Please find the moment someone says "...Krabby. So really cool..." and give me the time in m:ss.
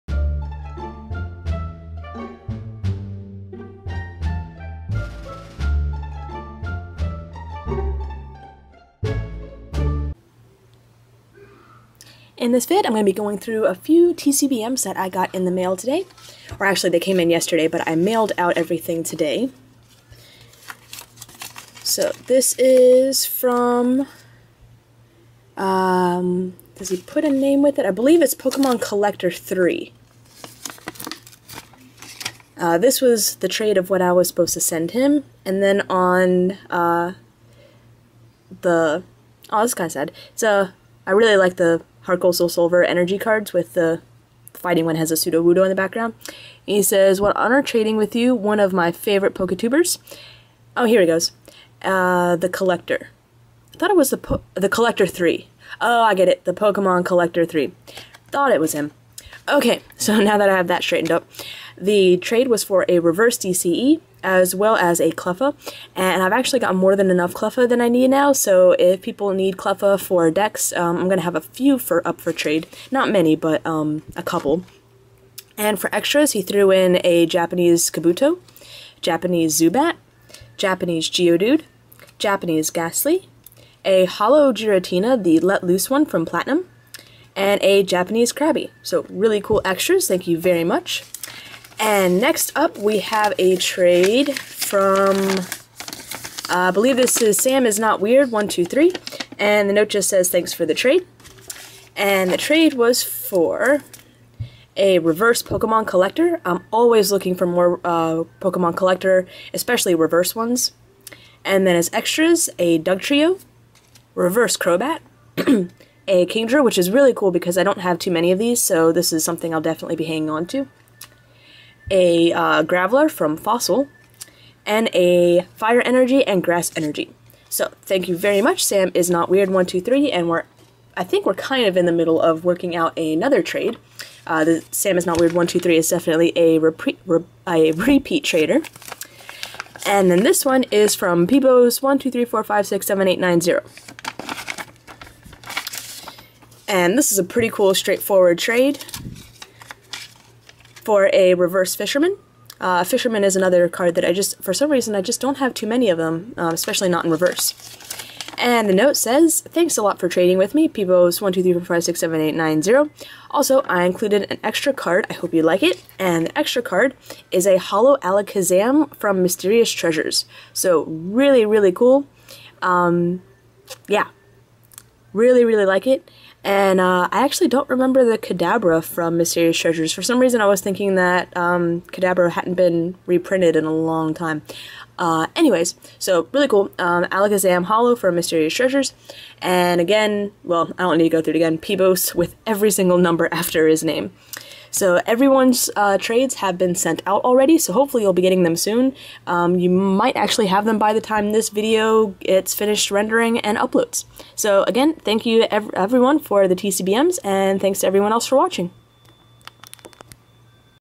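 1:28.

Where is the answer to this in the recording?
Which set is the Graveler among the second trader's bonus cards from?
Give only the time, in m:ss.
2:03.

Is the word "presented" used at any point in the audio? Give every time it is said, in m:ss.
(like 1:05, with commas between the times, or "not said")
not said.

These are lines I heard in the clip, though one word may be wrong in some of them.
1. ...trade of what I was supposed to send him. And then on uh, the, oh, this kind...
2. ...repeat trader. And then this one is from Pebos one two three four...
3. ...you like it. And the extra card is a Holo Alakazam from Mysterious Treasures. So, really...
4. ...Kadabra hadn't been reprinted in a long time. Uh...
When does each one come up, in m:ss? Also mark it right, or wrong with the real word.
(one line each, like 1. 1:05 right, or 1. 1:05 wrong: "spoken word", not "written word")
1. 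0:33 right
2. 2:17 right
3. 2:45 right
4. 3:01 right.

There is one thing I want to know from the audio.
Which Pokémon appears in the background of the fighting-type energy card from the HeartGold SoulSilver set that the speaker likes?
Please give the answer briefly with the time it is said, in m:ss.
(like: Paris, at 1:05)
Sudowoodo, at 0:45.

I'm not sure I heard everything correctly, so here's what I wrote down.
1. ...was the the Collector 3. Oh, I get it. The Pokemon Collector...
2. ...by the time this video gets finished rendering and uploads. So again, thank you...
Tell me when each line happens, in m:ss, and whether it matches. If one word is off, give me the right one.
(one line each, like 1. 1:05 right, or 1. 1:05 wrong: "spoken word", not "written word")
1. 0:53 right
2. 3:20 right.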